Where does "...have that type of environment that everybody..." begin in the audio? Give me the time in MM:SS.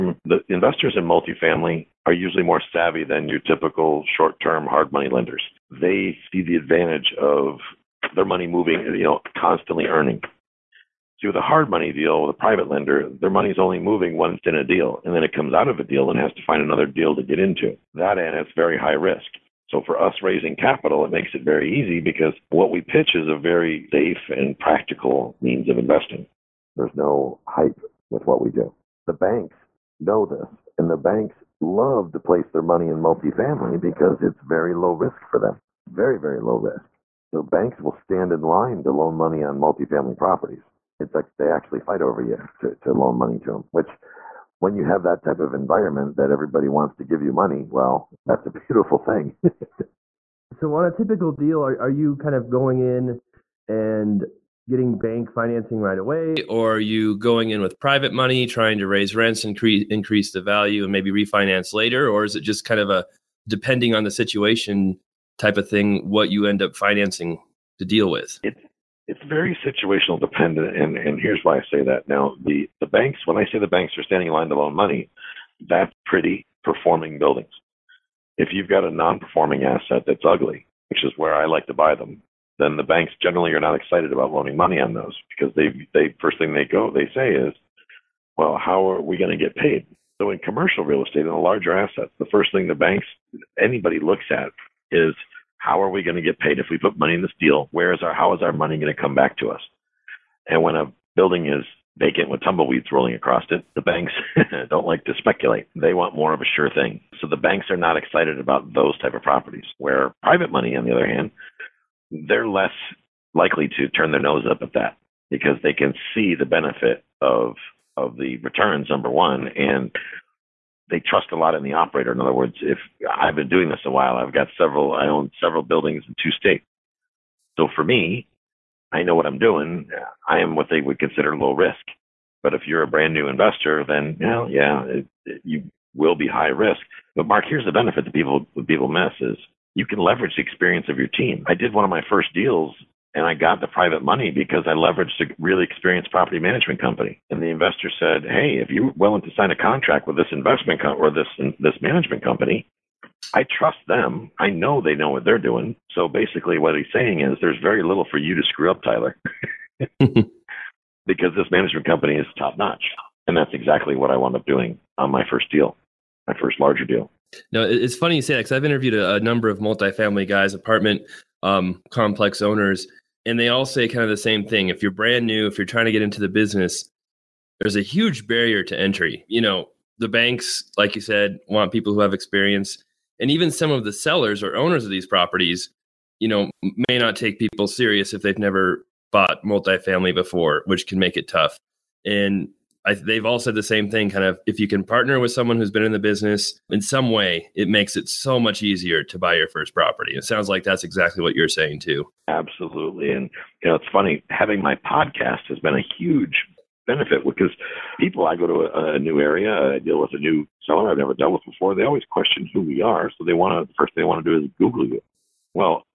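00:44.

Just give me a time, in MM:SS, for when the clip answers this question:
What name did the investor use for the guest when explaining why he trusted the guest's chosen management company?
02:38.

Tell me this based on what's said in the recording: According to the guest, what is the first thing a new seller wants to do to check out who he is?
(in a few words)
google you.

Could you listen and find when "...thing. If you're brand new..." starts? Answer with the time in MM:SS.
02:54.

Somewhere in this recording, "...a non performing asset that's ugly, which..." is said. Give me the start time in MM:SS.
01:18.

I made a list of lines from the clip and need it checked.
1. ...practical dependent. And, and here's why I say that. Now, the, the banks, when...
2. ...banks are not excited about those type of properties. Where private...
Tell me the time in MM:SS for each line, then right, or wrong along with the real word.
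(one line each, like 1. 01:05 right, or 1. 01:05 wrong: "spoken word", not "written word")
1. 01:09 wrong: "situational", not "practical"
2. 01:47 right.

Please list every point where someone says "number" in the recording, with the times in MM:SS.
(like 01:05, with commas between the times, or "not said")
01:58, 02:49.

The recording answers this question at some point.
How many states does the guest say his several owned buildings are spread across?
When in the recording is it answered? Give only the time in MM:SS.
02:06.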